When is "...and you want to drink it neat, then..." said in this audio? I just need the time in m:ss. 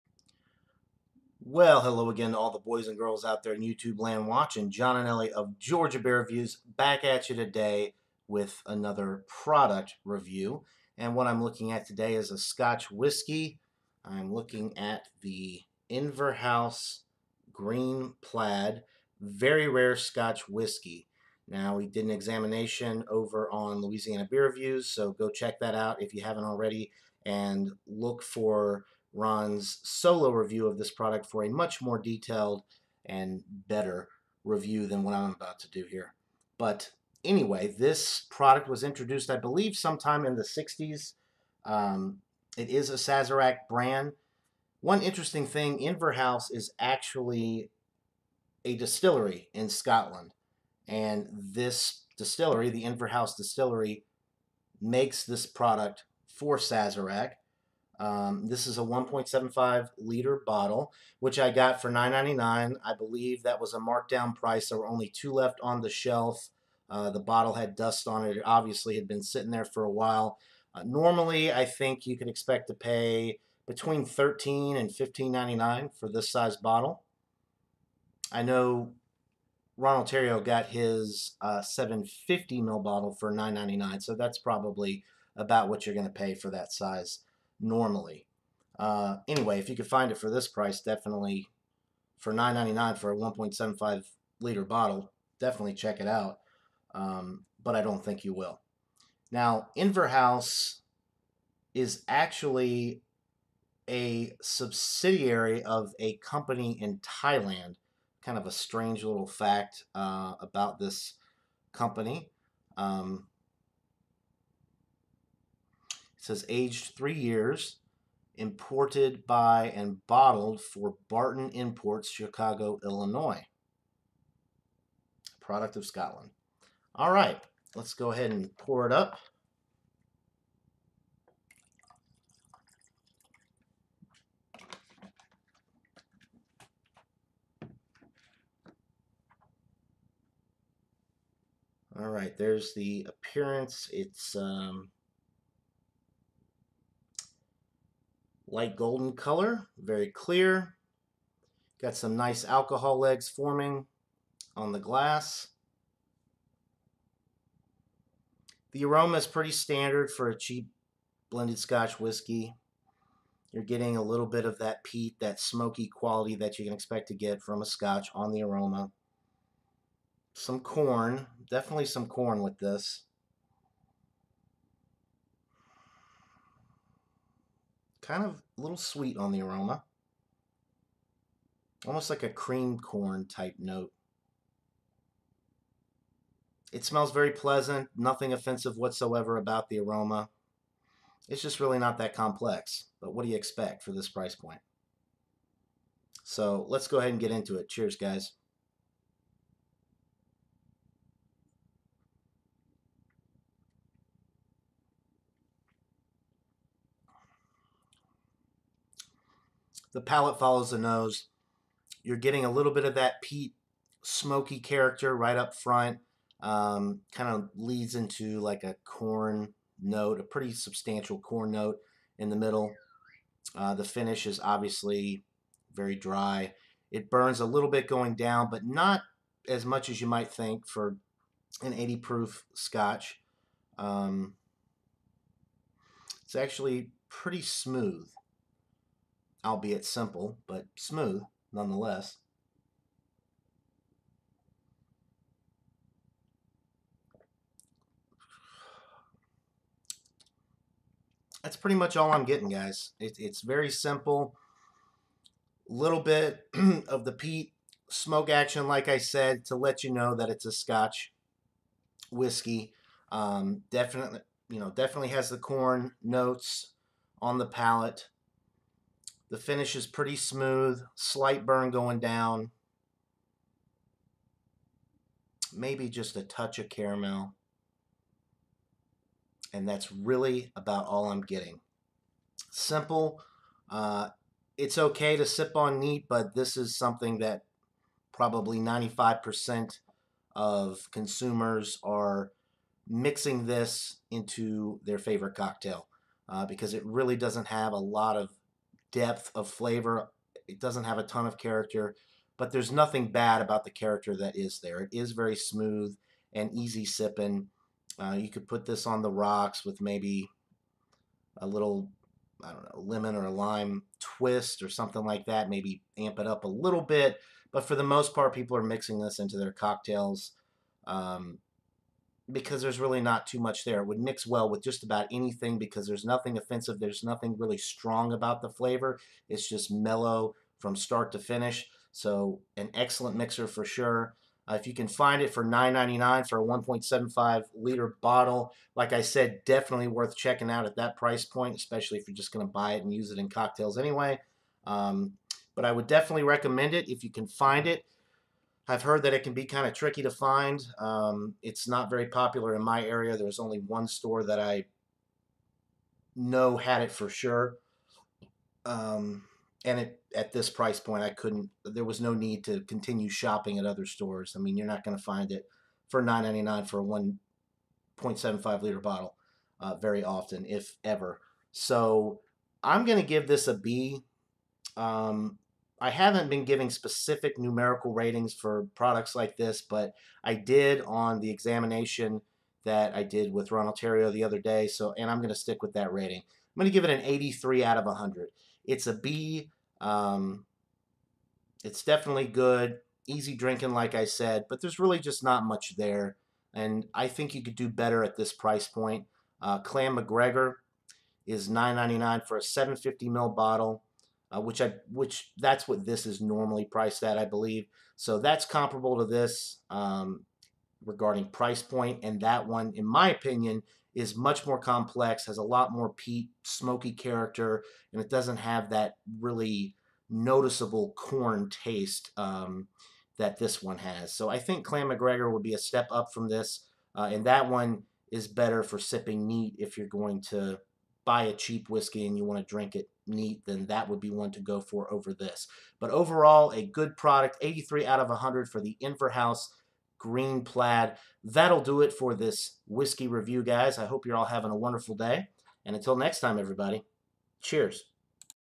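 7:12.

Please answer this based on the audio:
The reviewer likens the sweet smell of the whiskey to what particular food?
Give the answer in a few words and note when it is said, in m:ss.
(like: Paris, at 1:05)
Cream corn, at 3:02.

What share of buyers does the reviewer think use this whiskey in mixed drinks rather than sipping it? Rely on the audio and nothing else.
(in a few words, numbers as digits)
95%.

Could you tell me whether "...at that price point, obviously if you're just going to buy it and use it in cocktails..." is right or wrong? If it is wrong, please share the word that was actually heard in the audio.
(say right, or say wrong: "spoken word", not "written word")
wrong: "especially", not "obviously".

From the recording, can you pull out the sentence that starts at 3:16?
So let's go ahead and get into it.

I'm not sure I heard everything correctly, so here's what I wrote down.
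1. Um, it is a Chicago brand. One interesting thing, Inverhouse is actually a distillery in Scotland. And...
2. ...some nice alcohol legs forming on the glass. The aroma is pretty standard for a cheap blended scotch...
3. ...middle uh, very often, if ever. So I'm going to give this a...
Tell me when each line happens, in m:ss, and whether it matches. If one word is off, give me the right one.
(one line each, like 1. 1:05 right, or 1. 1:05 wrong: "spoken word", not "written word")
1. 0:41 wrong: "Sazerac", not "Chicago"
2. 2:31 right
3. 6:08 wrong: "bottle", not "middle".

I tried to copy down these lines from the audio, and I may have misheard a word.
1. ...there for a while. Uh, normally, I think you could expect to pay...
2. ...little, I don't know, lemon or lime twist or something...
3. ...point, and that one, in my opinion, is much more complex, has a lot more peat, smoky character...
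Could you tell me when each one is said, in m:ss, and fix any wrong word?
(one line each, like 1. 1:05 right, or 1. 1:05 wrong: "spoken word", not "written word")
1. 1:09 right
2. 5:11 right
3. 6:51 right.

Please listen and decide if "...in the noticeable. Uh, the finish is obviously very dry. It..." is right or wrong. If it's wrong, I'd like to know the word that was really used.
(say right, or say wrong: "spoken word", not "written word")
wrong: "middle", not "noticeable".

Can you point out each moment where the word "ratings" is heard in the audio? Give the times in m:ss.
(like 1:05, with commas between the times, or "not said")
6:17, 6:25.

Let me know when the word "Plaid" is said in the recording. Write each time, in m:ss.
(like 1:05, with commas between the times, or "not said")
0:18, 7:20.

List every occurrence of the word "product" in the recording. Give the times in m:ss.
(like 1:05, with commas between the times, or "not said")
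0:09, 0:30, 0:38, 0:55, 2:05, 6:18, 7:16.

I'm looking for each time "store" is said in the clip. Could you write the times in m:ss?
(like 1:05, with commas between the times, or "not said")
5:53, 6:03.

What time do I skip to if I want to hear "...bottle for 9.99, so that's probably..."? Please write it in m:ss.
1:22.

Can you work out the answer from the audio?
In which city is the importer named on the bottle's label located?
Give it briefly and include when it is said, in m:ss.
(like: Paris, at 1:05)
Chicago, at 2:02.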